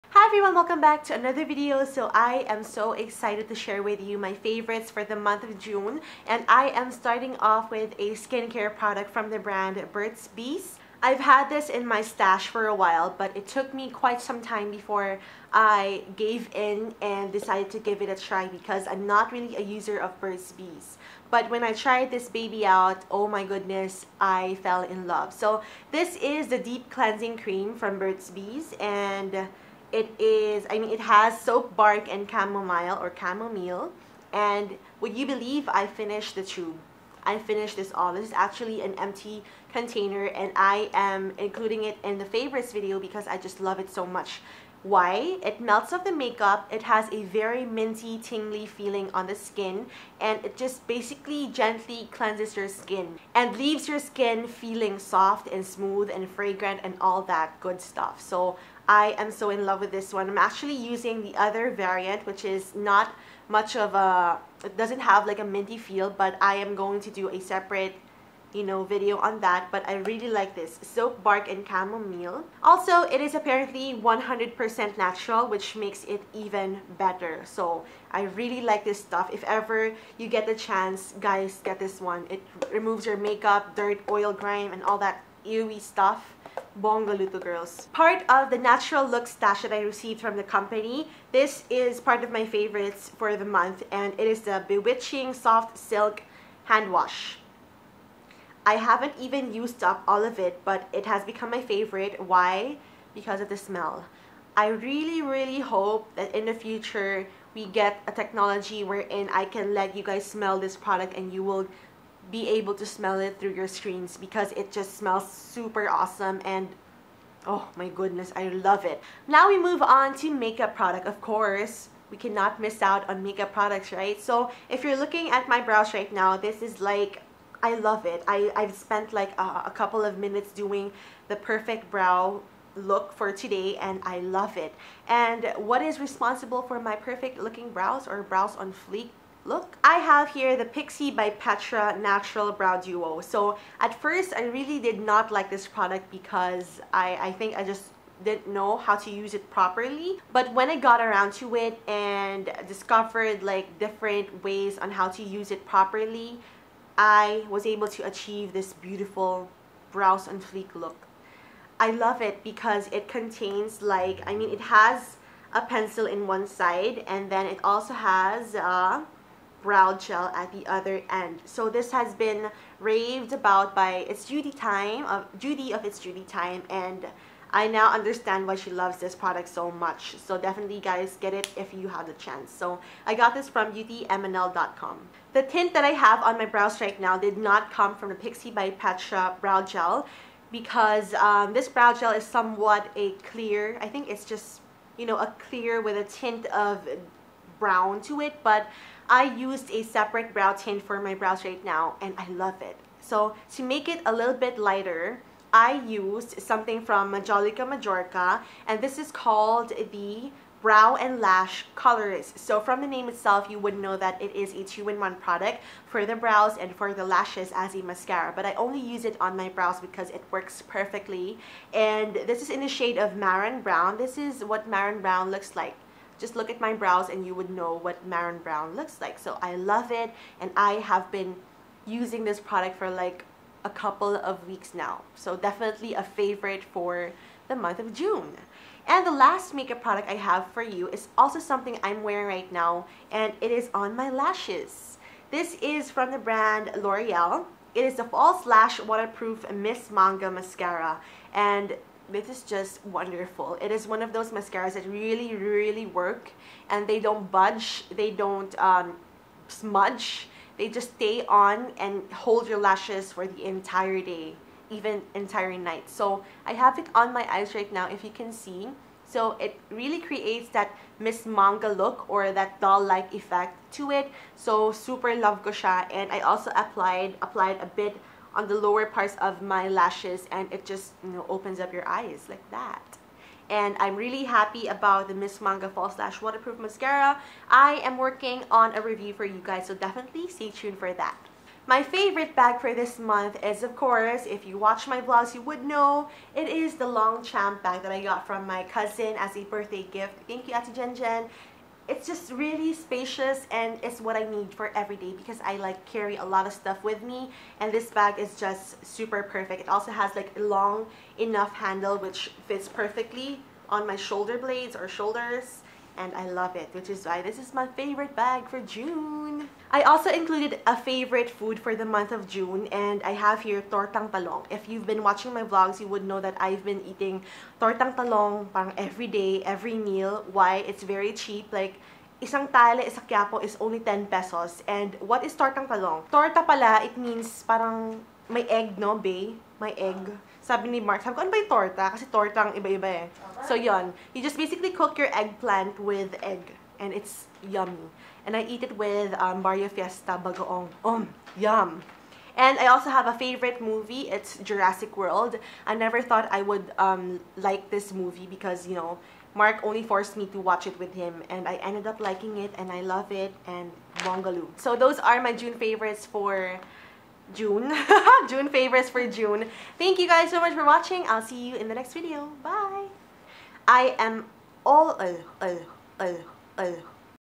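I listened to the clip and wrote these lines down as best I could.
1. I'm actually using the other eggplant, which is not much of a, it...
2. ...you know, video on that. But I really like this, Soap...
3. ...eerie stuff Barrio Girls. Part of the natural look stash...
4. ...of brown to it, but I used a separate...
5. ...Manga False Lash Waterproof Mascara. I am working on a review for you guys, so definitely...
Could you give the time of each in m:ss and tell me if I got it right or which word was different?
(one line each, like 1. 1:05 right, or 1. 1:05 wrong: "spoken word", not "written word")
1. 1:00 wrong: "variant", not "eggplant"
2. 1:08 right
3. 1:25 wrong: "Bongaluto", not "Barrio"
4. 3:16 right
5. 4:45 right.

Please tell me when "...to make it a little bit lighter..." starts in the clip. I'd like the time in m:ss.
3:23.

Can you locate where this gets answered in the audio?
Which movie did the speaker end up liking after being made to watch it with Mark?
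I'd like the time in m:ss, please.
5:54.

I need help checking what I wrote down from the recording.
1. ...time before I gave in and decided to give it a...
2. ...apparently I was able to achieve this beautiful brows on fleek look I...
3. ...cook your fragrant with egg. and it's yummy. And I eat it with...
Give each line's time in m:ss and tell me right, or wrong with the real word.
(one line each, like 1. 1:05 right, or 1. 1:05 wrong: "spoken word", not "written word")
1. 0:14 right
2. 2:35 wrong: "properly", not "apparently"
3. 5:44 wrong: "eggplant", not "fragrant".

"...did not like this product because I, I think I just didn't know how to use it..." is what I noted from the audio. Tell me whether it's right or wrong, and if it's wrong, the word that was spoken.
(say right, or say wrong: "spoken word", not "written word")
right.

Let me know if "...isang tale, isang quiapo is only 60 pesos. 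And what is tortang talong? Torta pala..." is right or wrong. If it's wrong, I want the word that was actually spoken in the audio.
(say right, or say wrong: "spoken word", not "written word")
wrong: "10", not "60".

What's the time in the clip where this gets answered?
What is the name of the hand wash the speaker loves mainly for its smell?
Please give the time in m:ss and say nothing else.
1:34.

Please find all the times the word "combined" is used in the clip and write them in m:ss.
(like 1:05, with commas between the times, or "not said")
not said.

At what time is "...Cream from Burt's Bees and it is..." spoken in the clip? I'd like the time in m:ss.
0:27.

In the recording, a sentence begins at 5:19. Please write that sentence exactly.
I also included a favorite food for the month of June and I have here tortang talong.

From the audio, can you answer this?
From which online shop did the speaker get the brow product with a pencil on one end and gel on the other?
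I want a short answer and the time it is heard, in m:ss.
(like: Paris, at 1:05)
beautymnl.com, at 3:03.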